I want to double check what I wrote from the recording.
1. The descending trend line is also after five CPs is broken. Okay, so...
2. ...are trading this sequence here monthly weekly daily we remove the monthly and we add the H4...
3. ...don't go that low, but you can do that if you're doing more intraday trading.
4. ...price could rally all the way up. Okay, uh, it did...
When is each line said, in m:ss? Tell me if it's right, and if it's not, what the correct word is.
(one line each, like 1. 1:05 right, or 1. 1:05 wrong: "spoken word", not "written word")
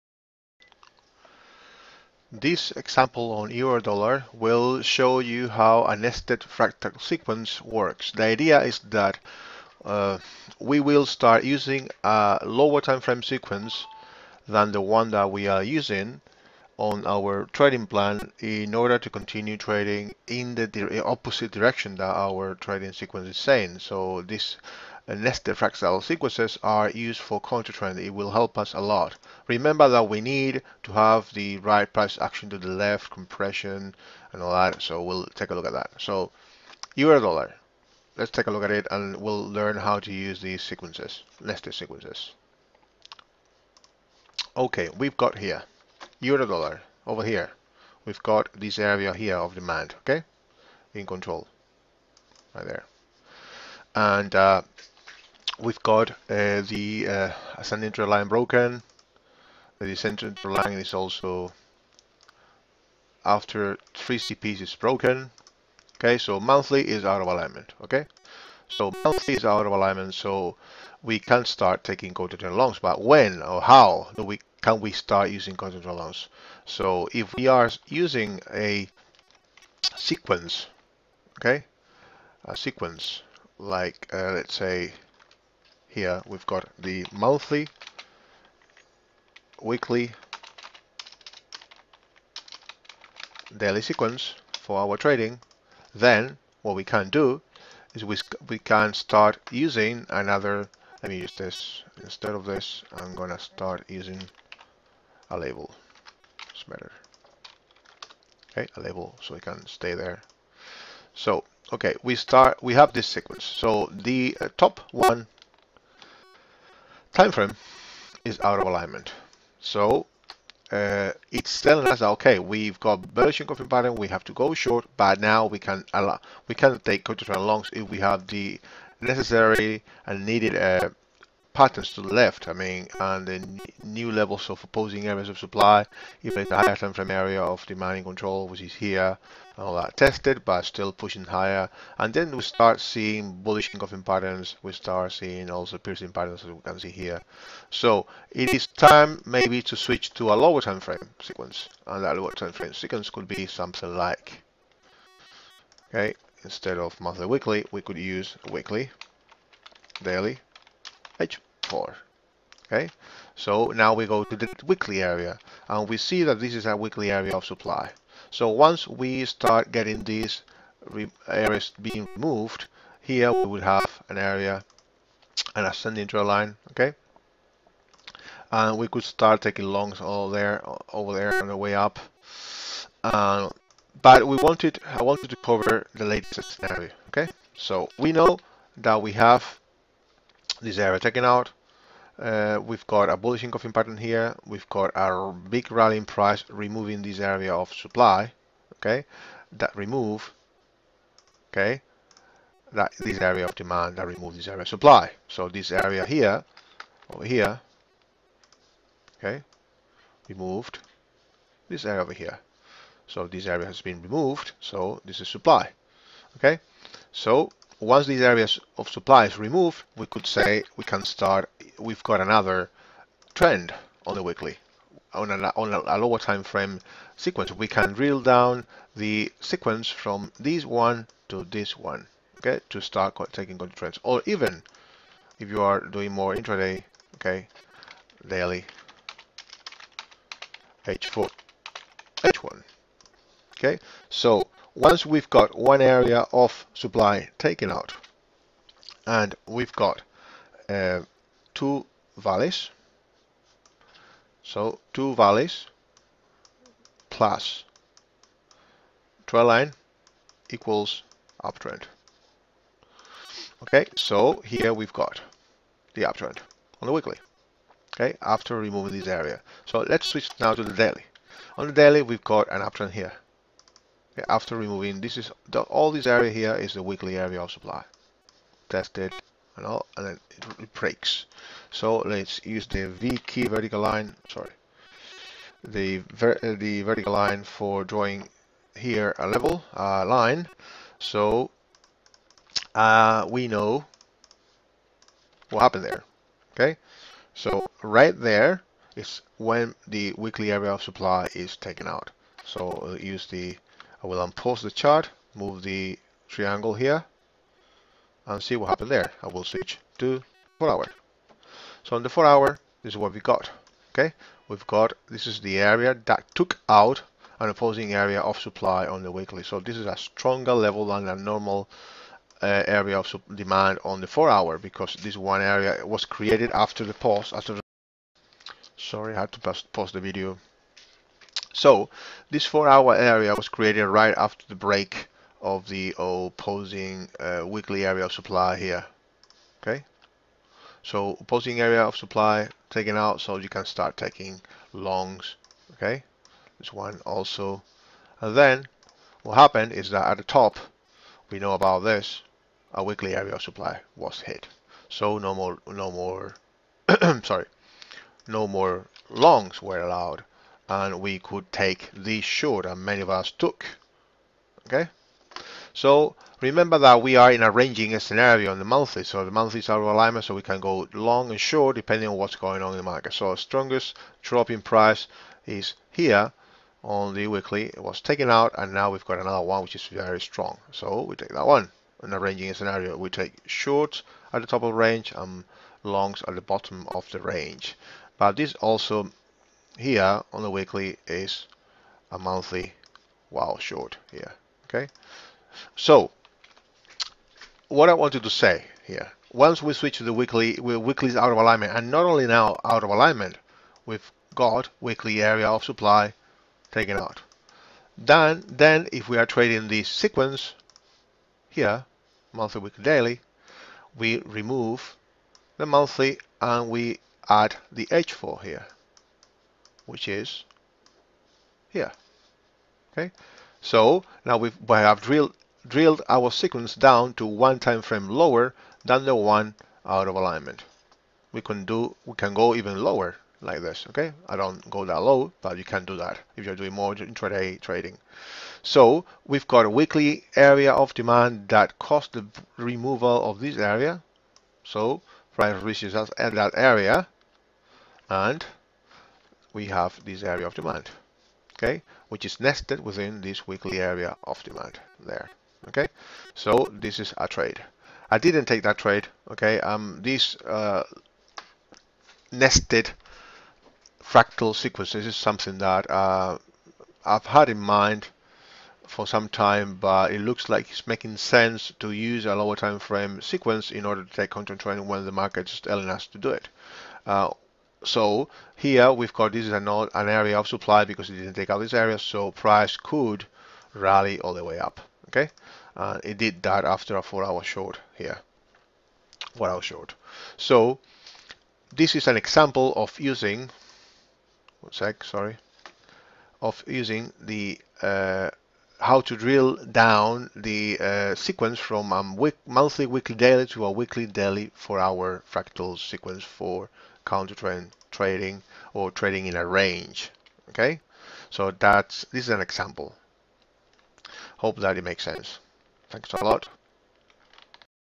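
1. 0:59 wrong: "three", not "five"
2. 6:49 right
3. 7:14 right
4. 8:02 right.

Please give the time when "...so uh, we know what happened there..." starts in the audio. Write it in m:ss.
4:50.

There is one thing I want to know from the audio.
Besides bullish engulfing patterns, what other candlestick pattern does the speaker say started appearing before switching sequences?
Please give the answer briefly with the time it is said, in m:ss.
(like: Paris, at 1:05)
Piercing patterns, at 2:25.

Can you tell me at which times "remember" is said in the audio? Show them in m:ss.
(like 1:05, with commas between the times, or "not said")
0:29, 6:06.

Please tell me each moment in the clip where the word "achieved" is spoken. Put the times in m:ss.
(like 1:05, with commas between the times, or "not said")
not said.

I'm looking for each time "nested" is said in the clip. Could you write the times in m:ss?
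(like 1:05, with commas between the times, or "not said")
0:05, 0:25, 0:41, 7:32, 7:42.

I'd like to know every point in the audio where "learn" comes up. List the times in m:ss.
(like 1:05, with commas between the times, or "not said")
0:39.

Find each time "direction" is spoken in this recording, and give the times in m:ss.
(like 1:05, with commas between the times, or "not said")
0:21.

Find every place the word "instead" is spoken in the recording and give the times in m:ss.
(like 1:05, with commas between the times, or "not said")
1:42, 2:36.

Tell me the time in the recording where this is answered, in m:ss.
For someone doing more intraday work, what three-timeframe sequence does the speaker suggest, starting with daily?
3:58.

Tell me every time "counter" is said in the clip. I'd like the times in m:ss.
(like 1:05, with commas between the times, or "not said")
3:53, 7:54, 8:27.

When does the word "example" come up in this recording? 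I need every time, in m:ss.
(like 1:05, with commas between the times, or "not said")
0:02, 8:12, 8:32.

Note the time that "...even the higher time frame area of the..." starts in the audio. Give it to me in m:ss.
2:16.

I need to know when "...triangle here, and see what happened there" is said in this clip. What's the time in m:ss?
5:06.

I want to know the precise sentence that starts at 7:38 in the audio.
I didn't take that trade, okay.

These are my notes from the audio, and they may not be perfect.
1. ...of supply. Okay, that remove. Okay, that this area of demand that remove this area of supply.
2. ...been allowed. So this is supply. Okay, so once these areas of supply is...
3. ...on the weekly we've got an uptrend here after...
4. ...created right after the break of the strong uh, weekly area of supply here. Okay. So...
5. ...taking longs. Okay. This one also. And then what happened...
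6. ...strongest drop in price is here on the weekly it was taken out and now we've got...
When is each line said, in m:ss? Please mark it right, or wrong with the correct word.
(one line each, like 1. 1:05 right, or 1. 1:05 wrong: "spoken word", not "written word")
1. 3:17 right
2. 3:33 wrong: "removed", not "allowed"
3. 4:31 wrong: "daily", not "weekly"
4. 5:33 wrong: "opposing", not "strong"
5. 5:43 right
6. 6:13 right.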